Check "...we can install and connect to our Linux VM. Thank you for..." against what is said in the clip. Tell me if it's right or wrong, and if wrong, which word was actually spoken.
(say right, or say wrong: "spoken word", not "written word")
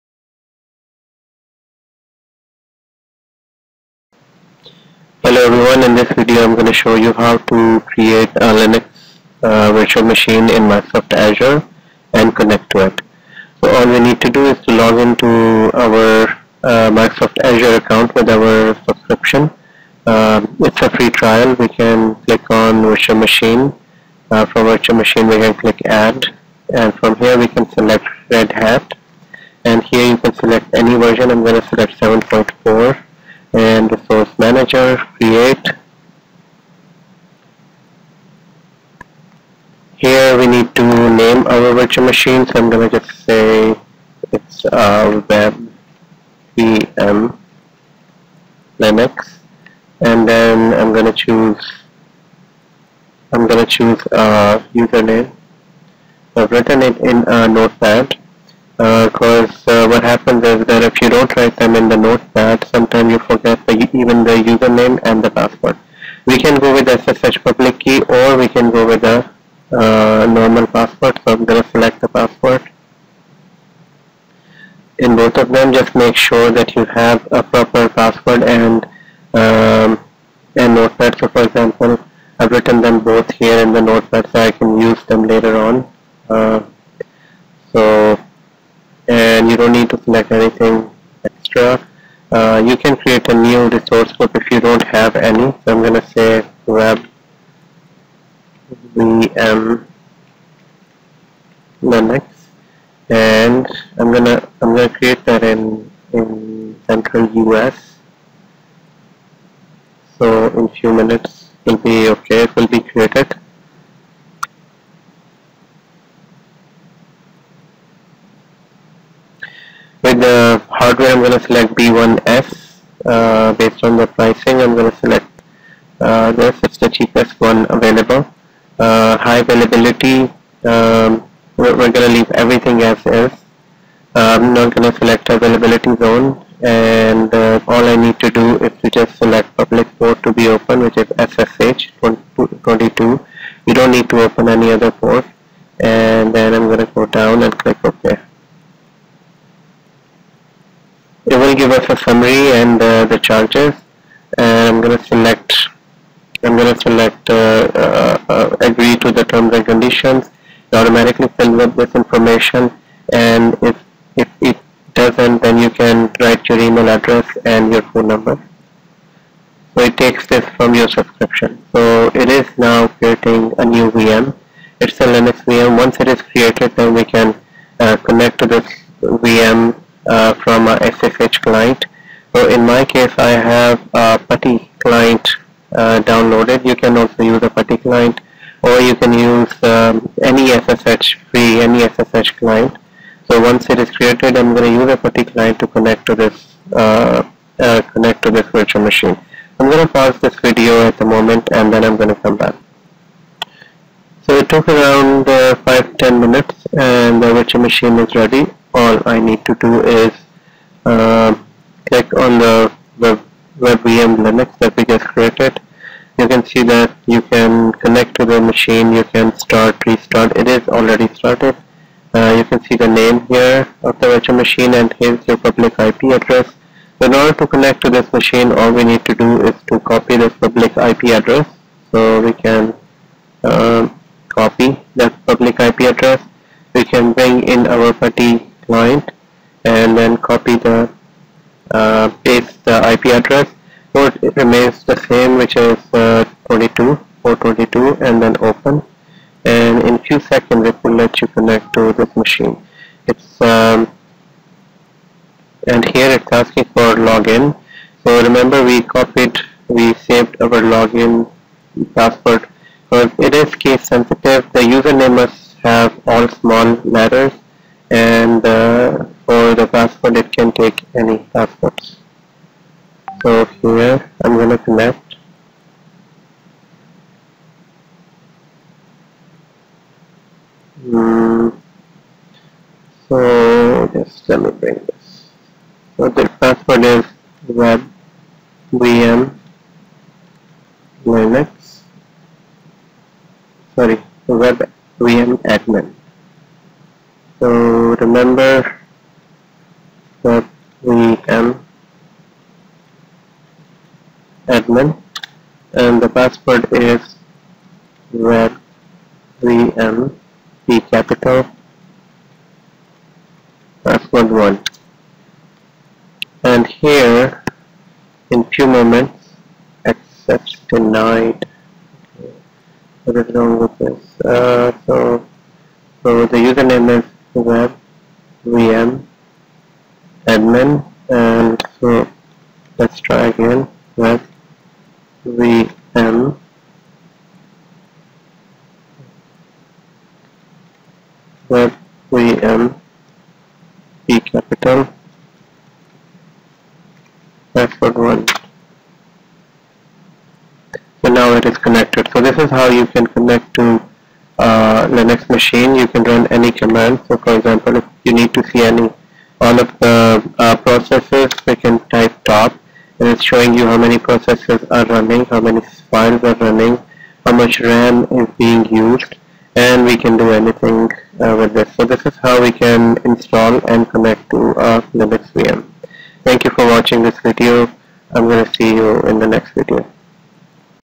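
right.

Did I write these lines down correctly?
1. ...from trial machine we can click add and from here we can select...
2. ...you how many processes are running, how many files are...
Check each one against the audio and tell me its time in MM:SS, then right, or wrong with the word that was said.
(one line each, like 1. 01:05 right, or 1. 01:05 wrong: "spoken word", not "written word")
1. 00:24 wrong: "virtual", not "trial"
2. 06:03 right.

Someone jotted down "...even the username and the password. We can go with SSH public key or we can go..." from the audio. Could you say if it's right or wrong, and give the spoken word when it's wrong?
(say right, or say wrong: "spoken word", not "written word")
right.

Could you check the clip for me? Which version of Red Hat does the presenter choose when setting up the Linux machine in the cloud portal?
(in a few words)
7.4.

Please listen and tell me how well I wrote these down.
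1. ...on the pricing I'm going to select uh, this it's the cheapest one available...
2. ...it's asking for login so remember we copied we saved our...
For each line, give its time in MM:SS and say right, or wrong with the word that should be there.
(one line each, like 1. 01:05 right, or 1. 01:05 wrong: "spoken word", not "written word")
1. 02:03 right
2. 04:16 right.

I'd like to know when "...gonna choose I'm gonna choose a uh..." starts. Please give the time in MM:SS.
00:50.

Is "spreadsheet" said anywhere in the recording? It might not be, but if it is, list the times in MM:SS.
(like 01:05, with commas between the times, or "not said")
not said.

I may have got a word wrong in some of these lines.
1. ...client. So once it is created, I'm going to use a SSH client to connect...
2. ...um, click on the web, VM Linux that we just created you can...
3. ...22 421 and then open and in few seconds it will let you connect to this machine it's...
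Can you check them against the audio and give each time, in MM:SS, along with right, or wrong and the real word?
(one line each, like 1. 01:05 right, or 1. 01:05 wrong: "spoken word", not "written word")
1. 03:12 wrong: "PuTTY", not "SSH"
2. 03:31 right
3. 04:06 wrong: "422", not "421".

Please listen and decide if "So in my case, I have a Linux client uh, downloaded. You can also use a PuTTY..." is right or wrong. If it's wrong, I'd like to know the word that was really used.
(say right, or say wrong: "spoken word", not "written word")
wrong: "PuTTY", not "Linux".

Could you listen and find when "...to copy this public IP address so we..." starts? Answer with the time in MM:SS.
03:49.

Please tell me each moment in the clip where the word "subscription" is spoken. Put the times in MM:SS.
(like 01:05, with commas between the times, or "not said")
00:18, 02:50.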